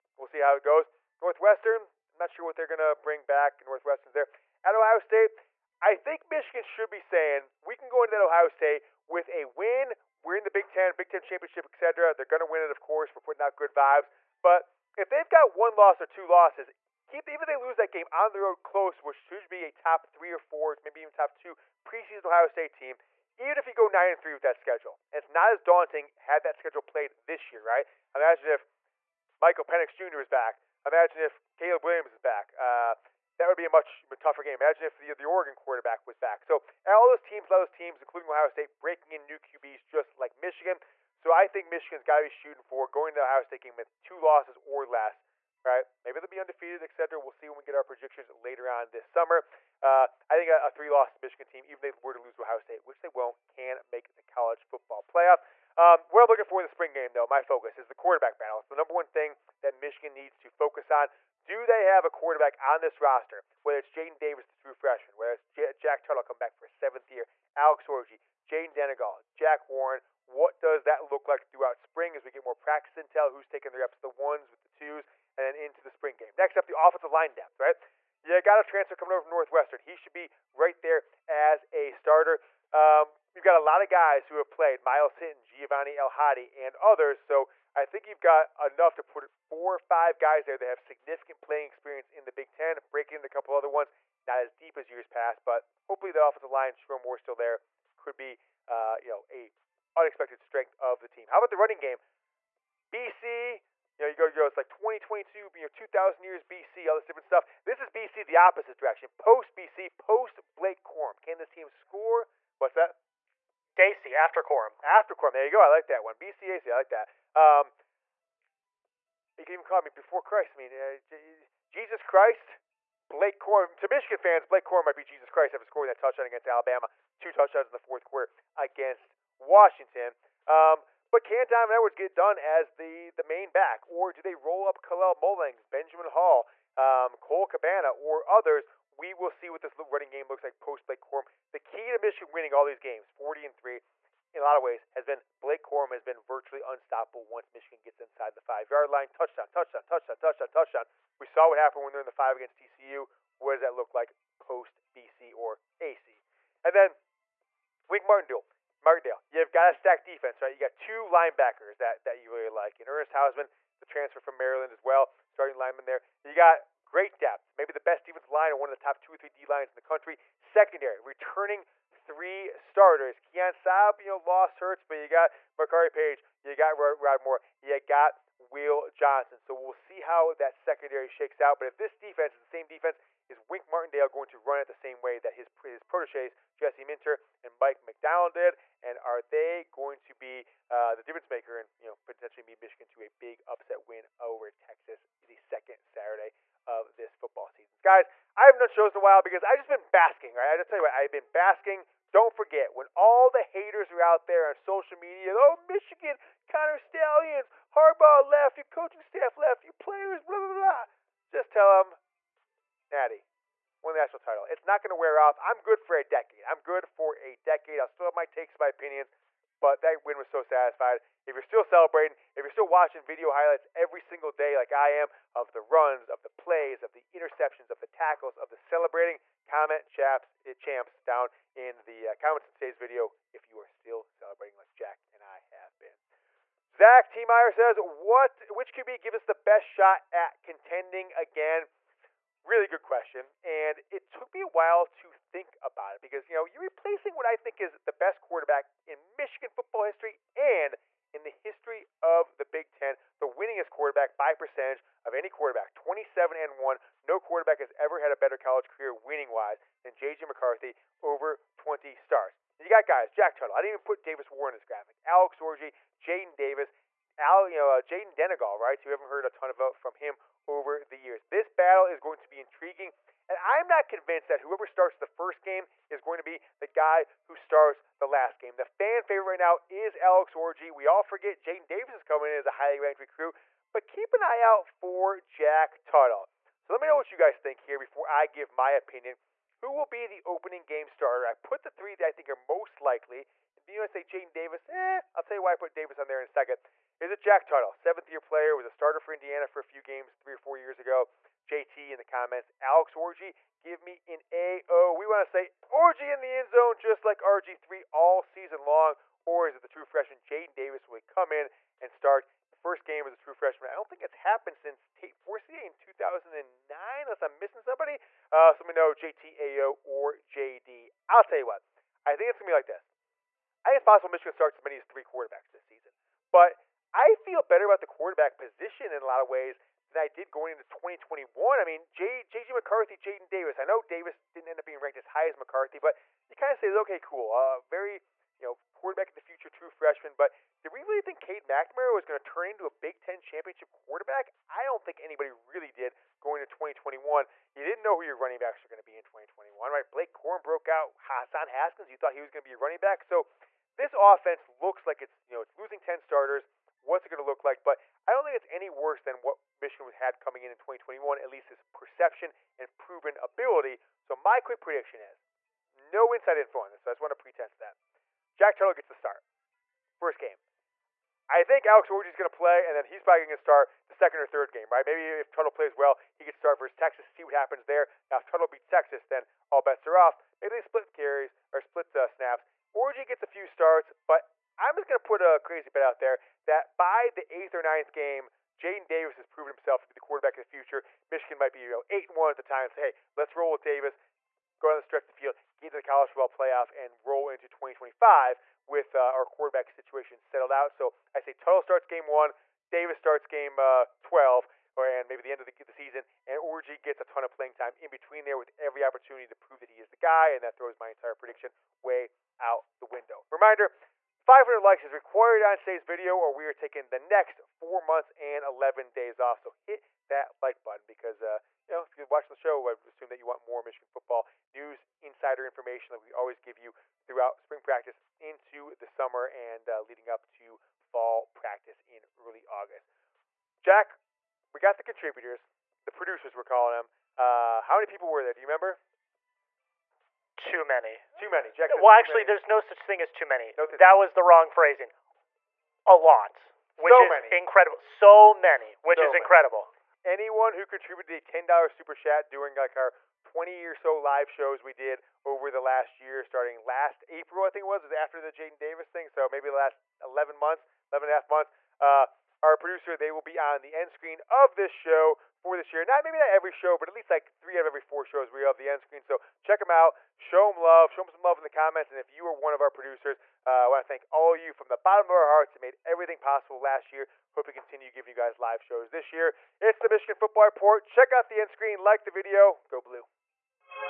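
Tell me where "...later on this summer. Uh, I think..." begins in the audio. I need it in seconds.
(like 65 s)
48 s.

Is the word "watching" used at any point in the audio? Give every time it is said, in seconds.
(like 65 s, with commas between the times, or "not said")
222 s, 422 s.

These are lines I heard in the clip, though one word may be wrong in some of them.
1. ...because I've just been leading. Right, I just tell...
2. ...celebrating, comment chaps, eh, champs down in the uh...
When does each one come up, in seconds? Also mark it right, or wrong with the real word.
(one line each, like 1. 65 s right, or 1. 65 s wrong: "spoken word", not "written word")
1. 199 s wrong: "basking", not "leading"
2. 228 s right.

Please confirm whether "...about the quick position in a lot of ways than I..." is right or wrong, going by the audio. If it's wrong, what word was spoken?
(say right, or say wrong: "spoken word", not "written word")
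wrong: "quarterback", not "quick".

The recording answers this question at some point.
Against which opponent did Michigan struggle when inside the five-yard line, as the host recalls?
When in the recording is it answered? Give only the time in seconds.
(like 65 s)
152 s.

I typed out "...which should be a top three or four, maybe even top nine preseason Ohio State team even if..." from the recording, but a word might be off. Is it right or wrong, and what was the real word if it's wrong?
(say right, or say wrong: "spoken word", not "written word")
wrong: "two", not "nine".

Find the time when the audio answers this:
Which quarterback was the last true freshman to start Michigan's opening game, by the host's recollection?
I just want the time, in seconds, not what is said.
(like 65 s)
314 s.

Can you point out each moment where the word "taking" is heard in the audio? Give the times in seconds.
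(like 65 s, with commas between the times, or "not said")
73 s, 416 s.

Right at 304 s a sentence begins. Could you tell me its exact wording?
We want to say Orgy in the end zone, just like RG3 all season long.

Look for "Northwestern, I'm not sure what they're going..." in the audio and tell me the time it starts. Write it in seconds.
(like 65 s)
1 s.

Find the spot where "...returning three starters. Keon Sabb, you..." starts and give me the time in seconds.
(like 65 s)
170 s.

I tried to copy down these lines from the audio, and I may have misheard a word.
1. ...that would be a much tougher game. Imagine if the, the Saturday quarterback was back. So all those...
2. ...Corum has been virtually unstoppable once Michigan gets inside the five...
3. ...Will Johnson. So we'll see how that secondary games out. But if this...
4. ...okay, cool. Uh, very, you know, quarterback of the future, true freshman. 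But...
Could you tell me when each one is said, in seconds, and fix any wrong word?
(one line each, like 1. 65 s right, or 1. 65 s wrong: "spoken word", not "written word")
1. 33 s wrong: "Oregon", not "Saturday"
2. 145 s right
3. 178 s wrong: "shakes", not "games"
4. 336 s right.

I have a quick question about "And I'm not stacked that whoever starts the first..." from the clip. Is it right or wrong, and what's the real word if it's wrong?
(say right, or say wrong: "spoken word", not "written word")
wrong: "convinced", not "stacked".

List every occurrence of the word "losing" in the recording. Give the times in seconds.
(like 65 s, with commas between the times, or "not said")
355 s.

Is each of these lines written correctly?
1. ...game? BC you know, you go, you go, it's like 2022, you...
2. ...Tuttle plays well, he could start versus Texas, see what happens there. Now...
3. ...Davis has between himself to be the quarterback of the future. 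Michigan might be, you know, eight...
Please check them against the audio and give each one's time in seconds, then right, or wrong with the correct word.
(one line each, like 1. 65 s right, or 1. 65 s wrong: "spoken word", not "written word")
1. 101 s right
2. 375 s right
3. 388 s wrong: "proven", not "between".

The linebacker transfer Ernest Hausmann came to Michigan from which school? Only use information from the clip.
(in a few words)
Maryland.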